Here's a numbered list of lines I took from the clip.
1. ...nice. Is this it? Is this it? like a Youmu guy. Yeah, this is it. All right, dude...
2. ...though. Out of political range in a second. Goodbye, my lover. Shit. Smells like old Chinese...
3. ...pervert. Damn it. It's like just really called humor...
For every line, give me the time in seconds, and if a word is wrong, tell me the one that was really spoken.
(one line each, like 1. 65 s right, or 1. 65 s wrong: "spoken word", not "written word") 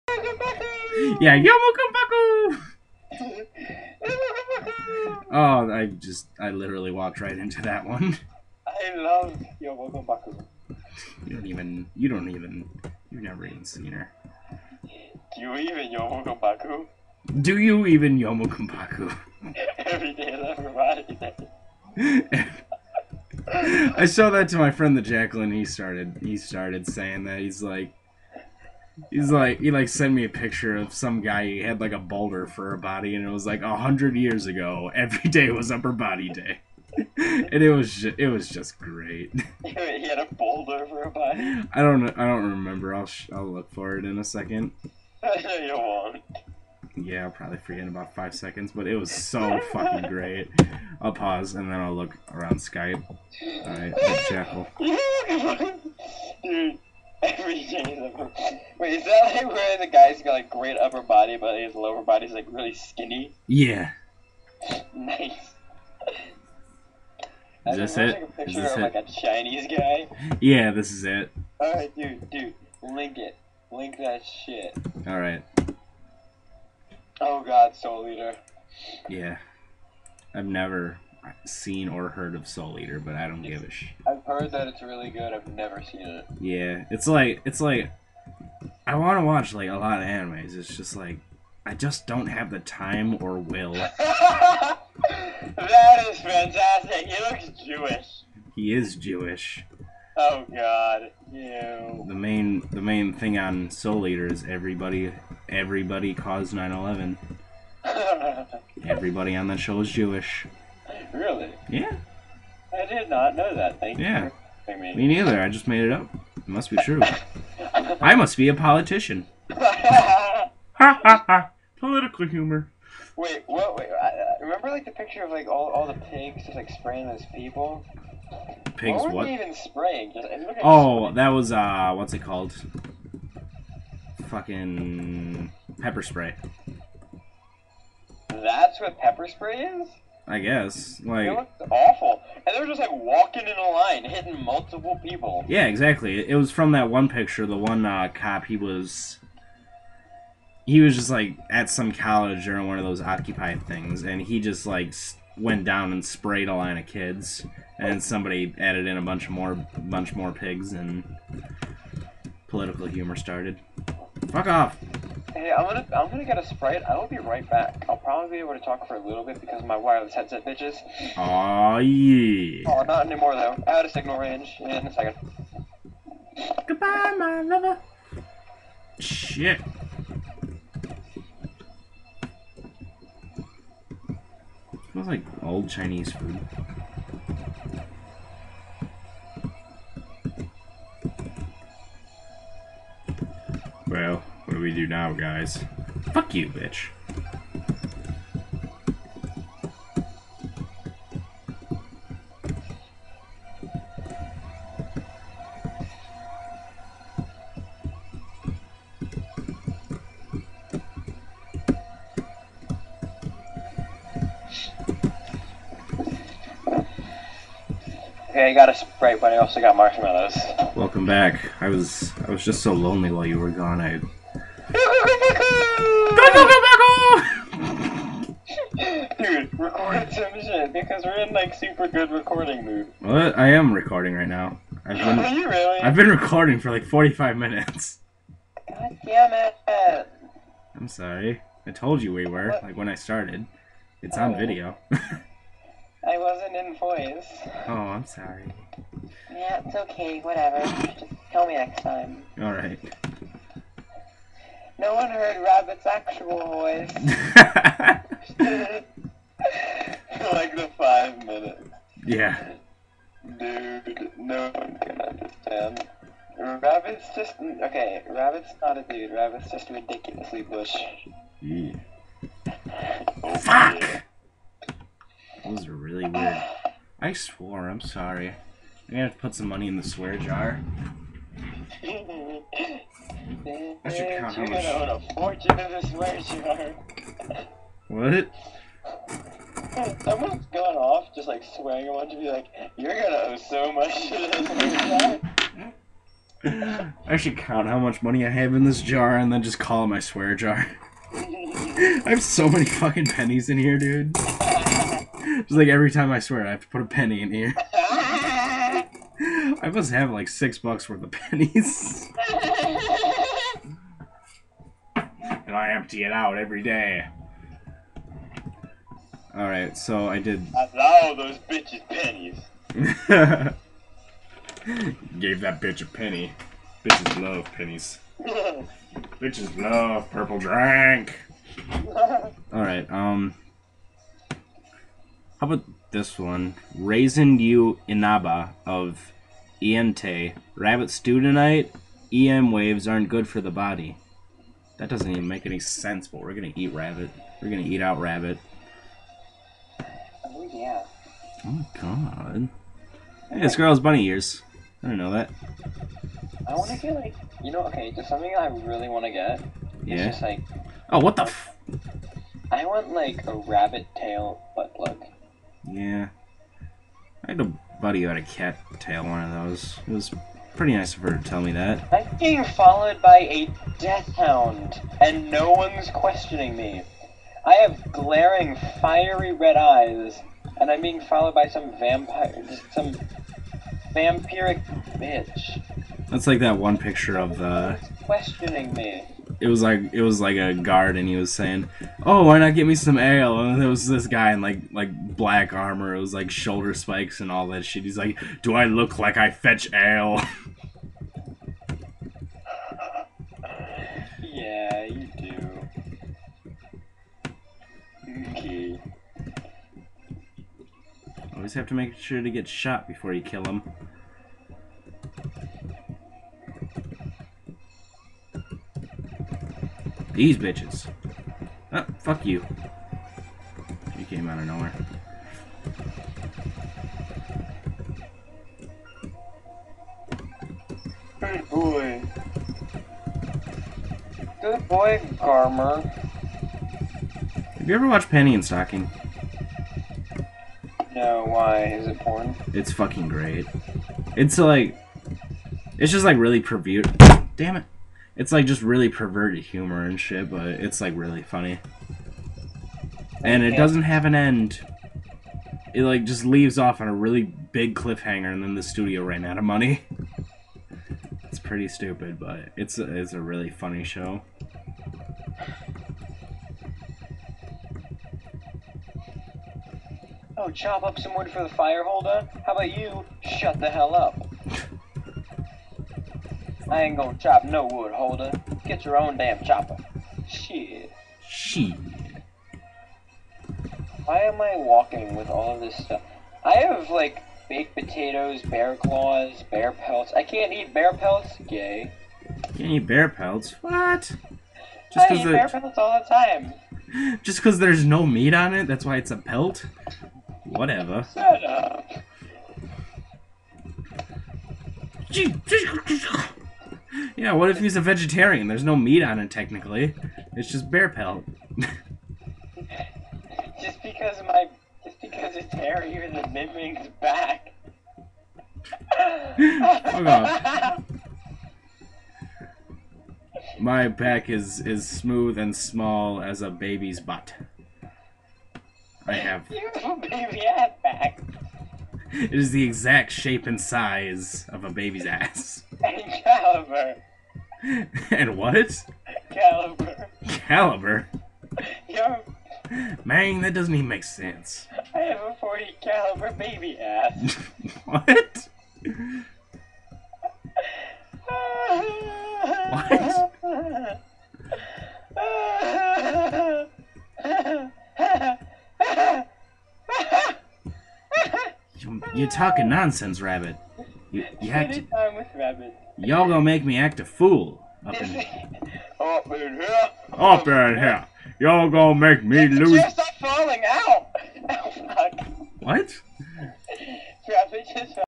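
1. 64 s wrong: "Chinese", not "Youmu"
2. 173 s wrong: "signal", not "political"
3. 446 s wrong: "perverted", not "called".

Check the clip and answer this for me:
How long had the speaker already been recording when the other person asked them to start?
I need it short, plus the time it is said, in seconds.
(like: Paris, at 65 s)
45 minutes, at 236 s.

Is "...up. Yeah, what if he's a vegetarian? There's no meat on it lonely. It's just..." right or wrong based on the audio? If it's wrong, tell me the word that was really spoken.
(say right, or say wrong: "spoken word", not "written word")
wrong: "technically", not "lonely".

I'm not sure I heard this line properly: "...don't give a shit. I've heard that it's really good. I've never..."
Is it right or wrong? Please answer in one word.
right.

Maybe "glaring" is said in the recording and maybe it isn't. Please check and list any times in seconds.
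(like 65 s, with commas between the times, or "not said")
377 s.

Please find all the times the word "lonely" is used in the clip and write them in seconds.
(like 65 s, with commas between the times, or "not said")
222 s.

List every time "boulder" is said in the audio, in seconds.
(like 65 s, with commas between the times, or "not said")
31 s, 40 s.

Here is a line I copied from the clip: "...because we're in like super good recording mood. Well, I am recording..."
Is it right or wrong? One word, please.
right.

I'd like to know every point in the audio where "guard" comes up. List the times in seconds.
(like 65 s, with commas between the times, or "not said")
390 s.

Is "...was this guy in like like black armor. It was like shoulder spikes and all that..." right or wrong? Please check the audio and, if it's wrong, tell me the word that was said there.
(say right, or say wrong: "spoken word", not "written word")
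right.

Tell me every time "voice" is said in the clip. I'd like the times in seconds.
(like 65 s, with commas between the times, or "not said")
246 s, 256 s.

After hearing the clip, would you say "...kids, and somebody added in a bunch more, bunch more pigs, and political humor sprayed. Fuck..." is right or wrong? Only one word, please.
wrong.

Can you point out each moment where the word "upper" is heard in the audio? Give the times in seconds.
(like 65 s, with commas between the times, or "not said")
35 s, 60 s.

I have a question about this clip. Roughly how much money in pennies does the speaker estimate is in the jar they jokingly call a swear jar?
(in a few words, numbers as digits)
6 bucks.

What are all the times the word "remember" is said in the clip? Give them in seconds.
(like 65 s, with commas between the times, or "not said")
42 s, 124 s.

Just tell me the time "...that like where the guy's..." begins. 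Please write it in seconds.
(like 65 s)
59 s.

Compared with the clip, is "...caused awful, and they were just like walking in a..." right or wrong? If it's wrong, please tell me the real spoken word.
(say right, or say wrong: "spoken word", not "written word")
wrong: "looked", not "caused".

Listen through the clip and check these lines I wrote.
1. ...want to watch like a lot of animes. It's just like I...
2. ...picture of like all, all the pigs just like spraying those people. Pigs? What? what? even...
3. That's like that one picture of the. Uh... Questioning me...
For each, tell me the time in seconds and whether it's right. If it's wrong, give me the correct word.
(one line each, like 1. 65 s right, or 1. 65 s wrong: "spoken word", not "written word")
1. 88 s right
2. 124 s right
3. 386 s right.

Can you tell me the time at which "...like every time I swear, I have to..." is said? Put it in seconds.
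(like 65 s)
305 s.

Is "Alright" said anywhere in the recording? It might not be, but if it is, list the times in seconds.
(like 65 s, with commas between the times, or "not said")
252 s, 319 s, 332 s.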